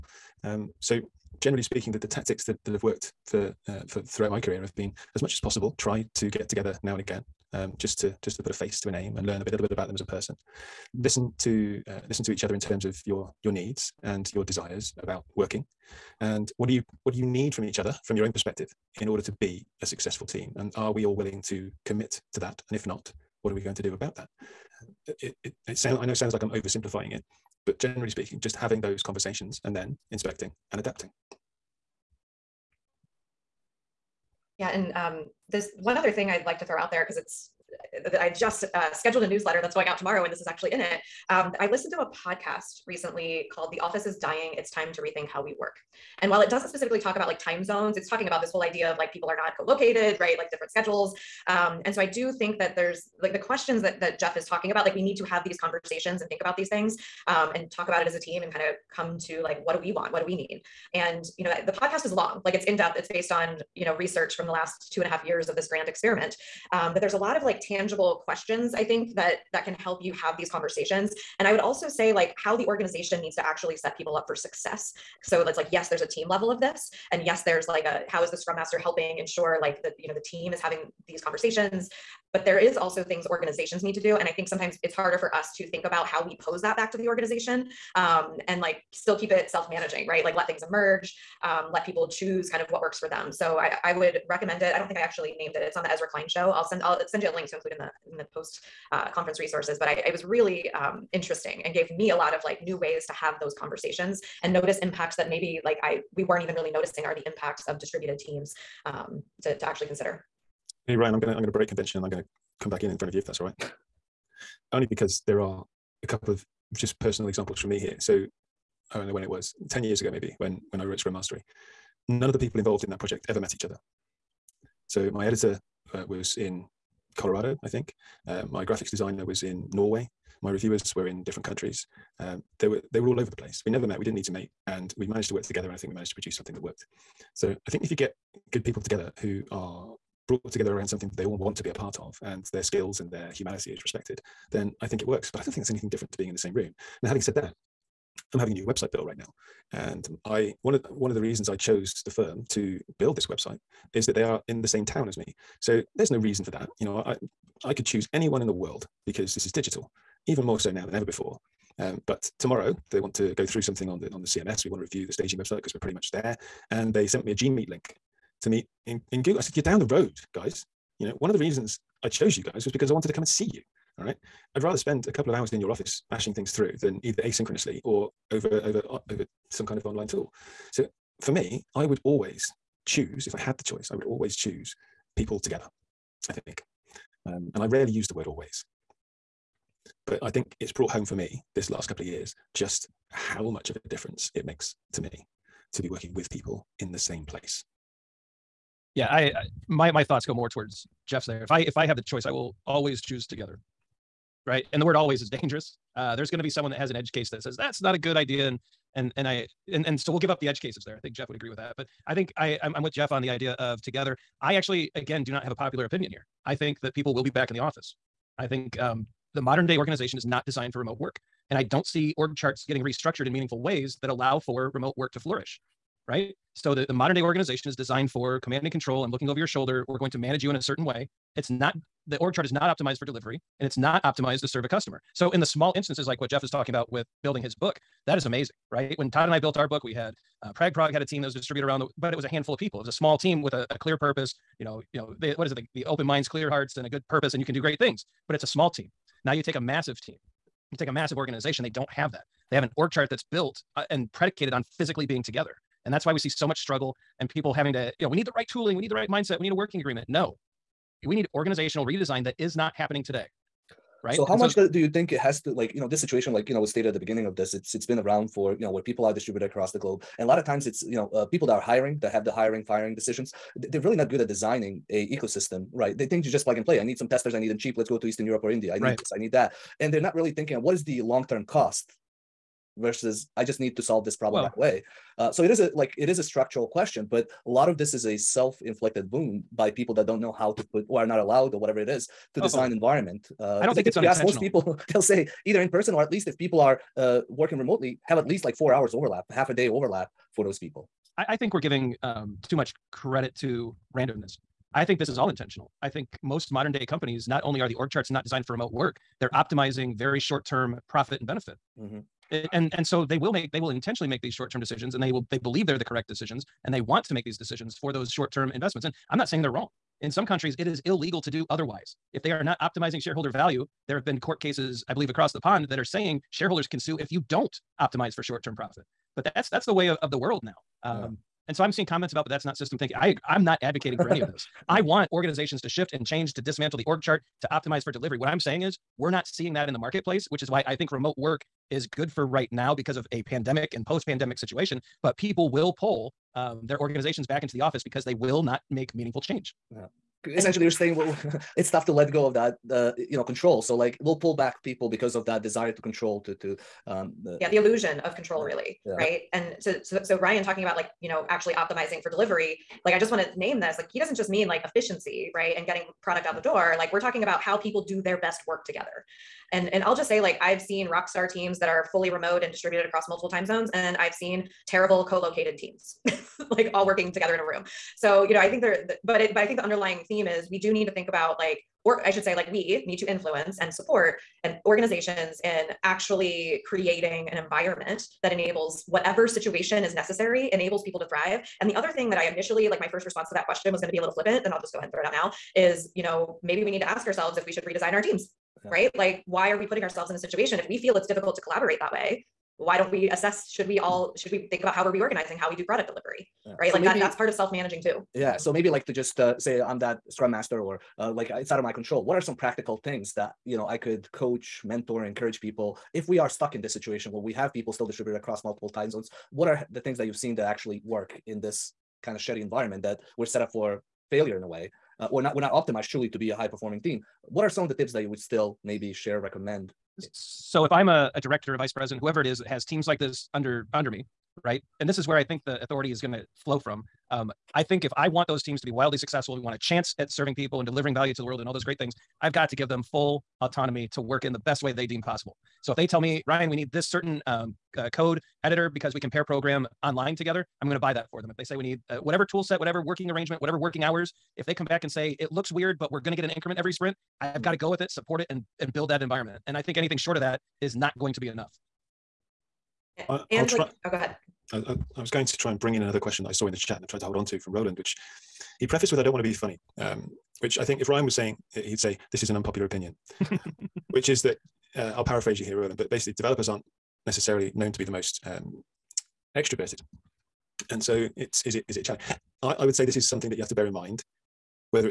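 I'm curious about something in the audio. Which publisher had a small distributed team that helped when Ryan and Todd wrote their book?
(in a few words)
Prag Prog.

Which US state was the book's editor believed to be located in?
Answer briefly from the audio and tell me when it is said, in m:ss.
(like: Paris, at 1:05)
Colorado, at 2:07.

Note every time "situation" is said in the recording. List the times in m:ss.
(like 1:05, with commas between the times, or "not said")
4:25, 5:44, 6:29, 6:40, 6:56.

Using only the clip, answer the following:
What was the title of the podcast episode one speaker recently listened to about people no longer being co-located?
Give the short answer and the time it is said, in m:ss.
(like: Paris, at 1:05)
The Office is Dying, at 0:43.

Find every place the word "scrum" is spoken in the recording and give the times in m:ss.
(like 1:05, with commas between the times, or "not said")
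1:18, 2:00, 6:50.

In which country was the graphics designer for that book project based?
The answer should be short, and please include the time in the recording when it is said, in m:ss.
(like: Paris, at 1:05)
Norway, at 2:09.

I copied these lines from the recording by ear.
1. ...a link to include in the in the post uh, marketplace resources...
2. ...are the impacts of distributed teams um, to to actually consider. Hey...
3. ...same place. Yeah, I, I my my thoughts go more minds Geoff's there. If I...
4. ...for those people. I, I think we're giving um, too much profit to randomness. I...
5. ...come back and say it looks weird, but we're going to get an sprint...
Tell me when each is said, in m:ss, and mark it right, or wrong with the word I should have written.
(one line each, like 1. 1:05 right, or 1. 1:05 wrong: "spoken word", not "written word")
1. 1:37 wrong: "conference", not "marketplace"
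2. 1:47 right
3. 3:16 wrong: "towards", not "minds"
4. 5:00 wrong: "credit", not "profit"
5. 7:34 wrong: "increment", not "sprint".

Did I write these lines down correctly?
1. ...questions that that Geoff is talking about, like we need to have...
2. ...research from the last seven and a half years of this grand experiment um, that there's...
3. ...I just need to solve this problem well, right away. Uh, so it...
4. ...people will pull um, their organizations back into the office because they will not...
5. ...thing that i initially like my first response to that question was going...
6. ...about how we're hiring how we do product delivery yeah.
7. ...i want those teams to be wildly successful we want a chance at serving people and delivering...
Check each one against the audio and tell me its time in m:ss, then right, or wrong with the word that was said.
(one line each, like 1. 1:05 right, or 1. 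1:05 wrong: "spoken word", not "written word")
1. 0:53 right
2. 1:03 wrong: "two", not "seven"
3. 4:43 right
4. 5:45 right
5. 6:31 right
6. 6:44 wrong: "reorganizing", not "hiring"
7. 7:17 right.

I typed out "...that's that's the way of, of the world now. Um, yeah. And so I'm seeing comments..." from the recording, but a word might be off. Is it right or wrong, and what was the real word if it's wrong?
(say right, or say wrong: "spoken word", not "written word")
right.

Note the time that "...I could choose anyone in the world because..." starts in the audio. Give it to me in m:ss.
2:37.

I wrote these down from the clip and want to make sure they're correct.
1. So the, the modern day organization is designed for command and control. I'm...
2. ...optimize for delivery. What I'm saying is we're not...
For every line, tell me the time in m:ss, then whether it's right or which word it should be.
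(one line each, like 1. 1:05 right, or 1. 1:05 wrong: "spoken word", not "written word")
1. 3:46 right
2. 5:37 right.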